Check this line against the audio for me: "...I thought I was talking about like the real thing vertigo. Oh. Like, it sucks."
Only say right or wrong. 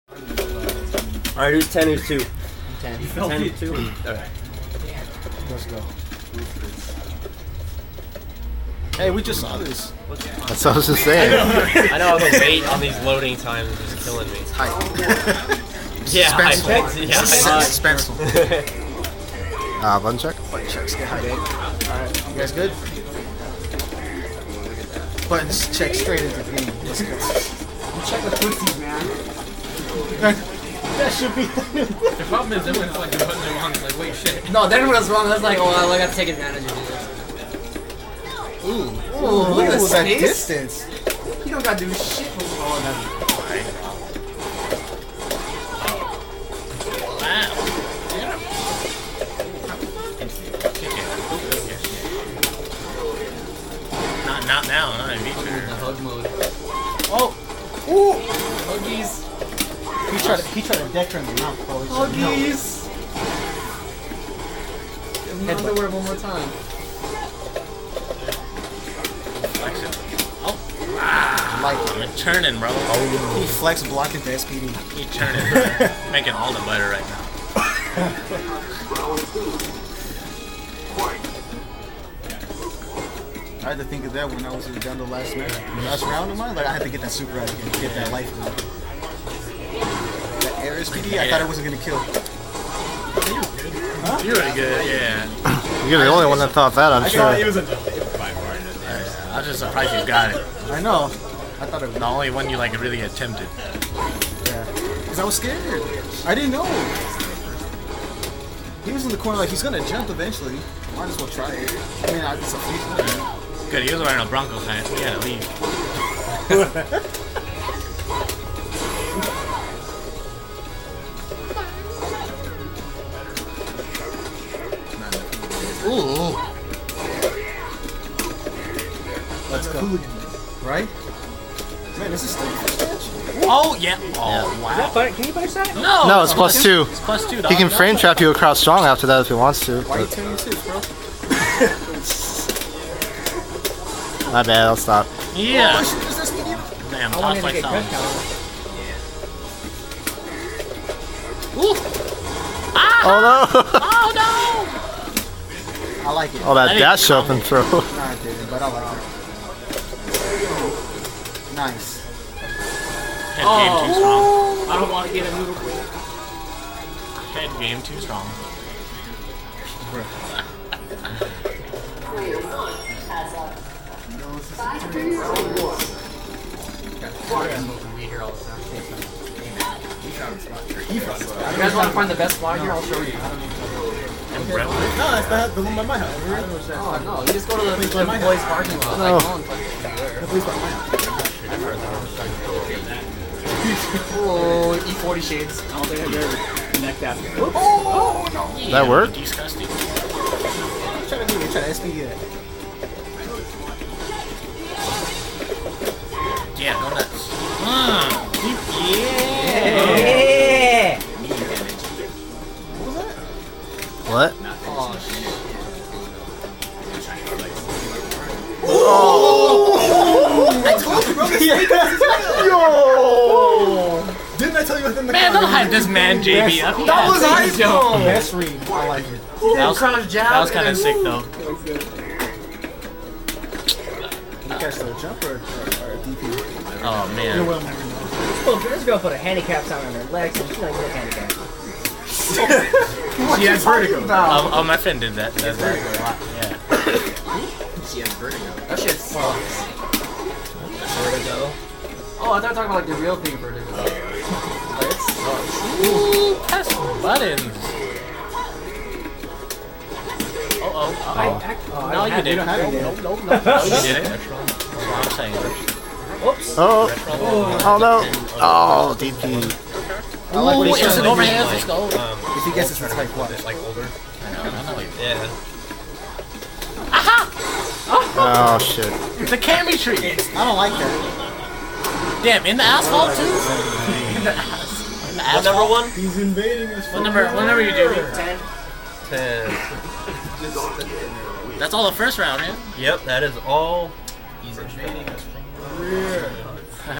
right.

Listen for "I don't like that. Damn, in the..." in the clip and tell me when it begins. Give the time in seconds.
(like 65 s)
280 s.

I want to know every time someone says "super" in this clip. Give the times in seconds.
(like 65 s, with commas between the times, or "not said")
87 s.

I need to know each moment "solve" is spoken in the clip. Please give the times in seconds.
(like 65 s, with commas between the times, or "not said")
not said.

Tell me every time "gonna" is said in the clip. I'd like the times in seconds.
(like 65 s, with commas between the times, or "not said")
91 s, 109 s.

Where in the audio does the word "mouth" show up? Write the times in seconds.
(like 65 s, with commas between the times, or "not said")
61 s.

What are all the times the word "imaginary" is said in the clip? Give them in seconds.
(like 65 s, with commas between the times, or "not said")
not said.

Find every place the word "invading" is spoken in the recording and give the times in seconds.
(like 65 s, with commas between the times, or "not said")
286 s, 294 s.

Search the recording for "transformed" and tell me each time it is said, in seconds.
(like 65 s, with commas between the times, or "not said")
not said.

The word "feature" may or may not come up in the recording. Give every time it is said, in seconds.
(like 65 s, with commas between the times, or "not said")
55 s.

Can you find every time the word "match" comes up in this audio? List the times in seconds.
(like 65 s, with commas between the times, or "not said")
85 s.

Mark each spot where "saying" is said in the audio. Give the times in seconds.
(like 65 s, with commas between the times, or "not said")
11 s, 265 s.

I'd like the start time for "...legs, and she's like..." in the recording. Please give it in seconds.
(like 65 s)
240 s.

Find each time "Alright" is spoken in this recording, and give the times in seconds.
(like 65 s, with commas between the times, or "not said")
21 s.